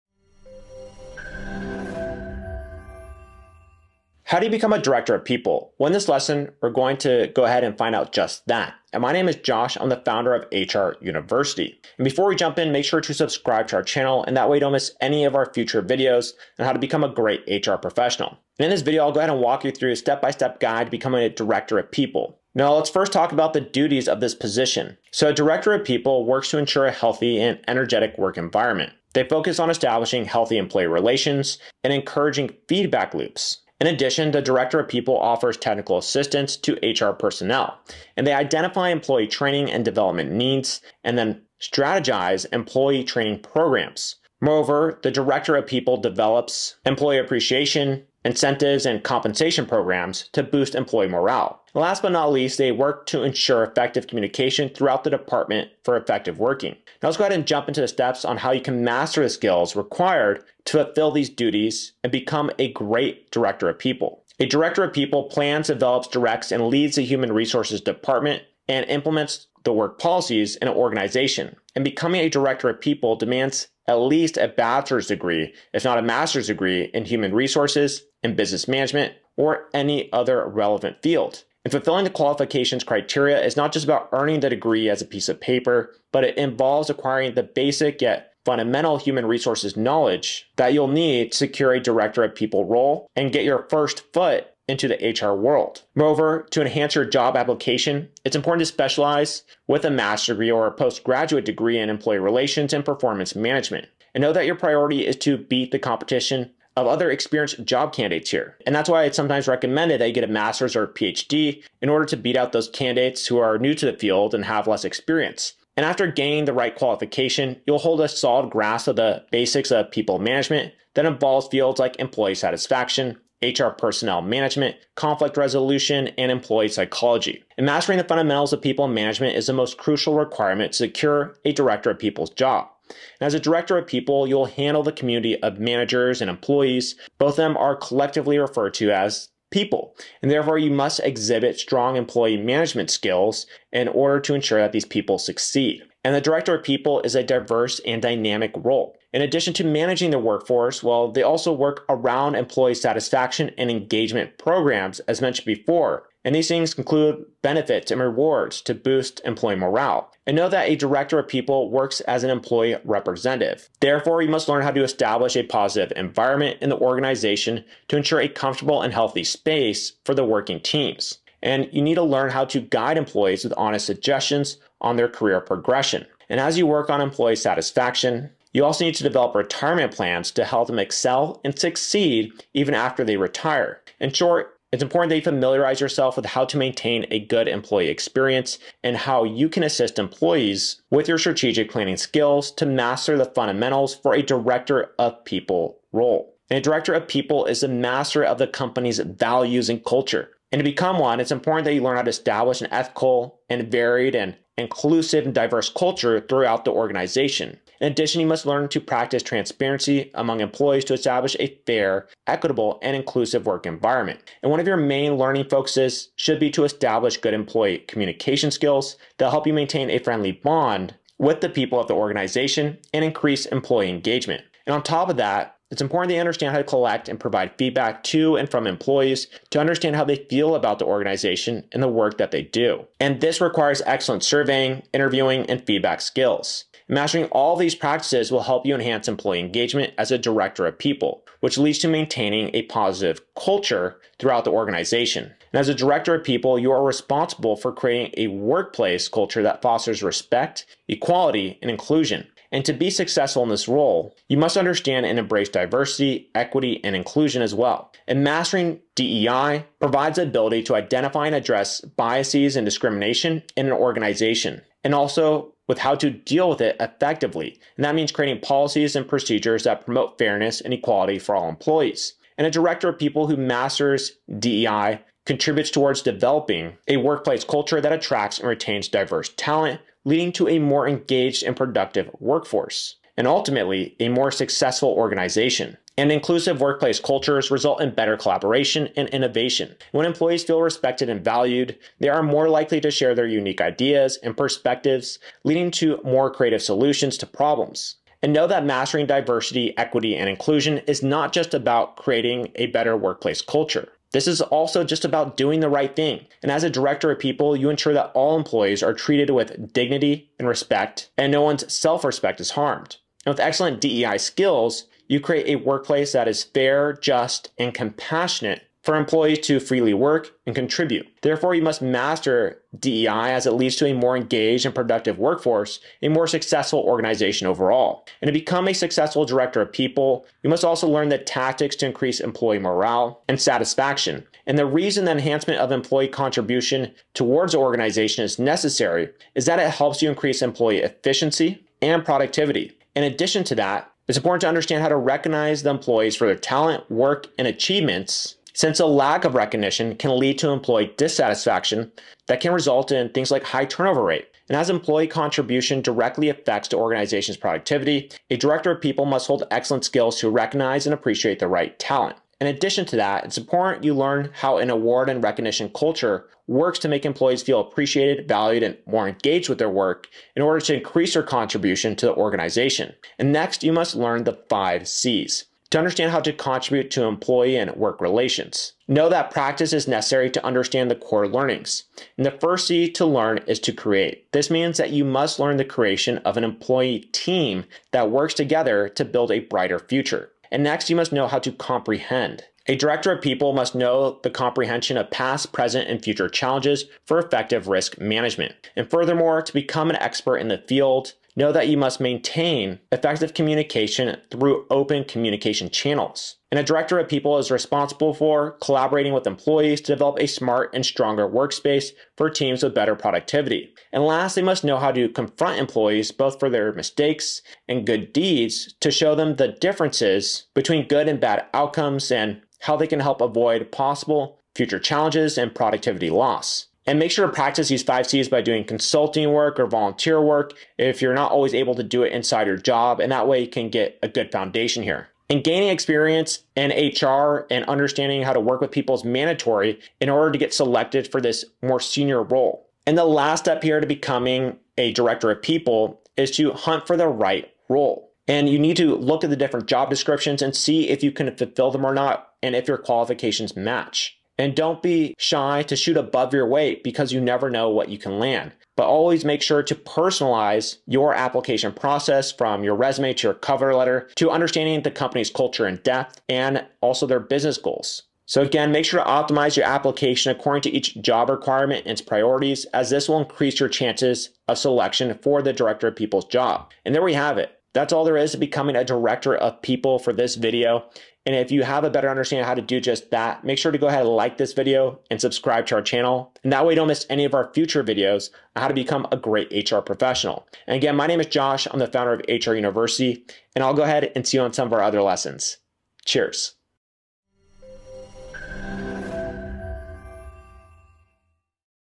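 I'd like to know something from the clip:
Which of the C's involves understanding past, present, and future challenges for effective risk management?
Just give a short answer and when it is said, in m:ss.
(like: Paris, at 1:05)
comprehend, at 6:31.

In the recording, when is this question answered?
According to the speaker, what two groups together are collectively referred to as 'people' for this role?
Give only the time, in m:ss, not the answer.
2:15.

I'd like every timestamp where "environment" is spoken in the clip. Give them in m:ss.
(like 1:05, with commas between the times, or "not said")
0:28, 2:45, 3:33.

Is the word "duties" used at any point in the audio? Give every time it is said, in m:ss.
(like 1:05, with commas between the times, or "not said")
0:23, 1:01.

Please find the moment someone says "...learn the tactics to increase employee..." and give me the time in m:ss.
5:30.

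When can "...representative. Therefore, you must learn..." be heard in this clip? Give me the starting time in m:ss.
2:42.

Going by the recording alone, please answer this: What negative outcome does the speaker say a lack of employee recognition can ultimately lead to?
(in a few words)
high turnover rate.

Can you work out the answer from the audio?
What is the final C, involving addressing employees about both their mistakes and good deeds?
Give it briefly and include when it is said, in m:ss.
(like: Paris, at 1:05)
confront, at 6:55.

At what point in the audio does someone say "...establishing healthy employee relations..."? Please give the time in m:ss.
0:29.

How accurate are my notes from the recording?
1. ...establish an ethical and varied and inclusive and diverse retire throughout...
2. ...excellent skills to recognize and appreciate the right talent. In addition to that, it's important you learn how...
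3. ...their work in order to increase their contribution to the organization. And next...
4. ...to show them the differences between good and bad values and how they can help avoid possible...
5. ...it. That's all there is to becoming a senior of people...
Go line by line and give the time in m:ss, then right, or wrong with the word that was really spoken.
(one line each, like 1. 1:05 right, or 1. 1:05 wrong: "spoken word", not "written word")
1. 3:22 wrong: "culture", not "retire"
2. 5:59 right
3. 6:09 right
4. 6:58 wrong: "outcomes", not "values"
5. 7:57 wrong: "director", not "senior".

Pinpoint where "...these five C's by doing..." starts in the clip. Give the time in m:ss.
7:07.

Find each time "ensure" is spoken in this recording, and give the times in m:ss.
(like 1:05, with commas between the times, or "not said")
0:26, 0:53, 2:24, 2:47, 5:07.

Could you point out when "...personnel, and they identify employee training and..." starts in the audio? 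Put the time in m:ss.
0:37.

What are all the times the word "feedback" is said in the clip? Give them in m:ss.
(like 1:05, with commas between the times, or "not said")
0:32, 3:47, 3:55.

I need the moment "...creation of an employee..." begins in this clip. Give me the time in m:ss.
6:25.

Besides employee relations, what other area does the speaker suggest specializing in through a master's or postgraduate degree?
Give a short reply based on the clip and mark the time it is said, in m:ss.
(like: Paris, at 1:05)
performance management, at 1:42.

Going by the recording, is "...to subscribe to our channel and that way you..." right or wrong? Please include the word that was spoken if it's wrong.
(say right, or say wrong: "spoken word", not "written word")
right.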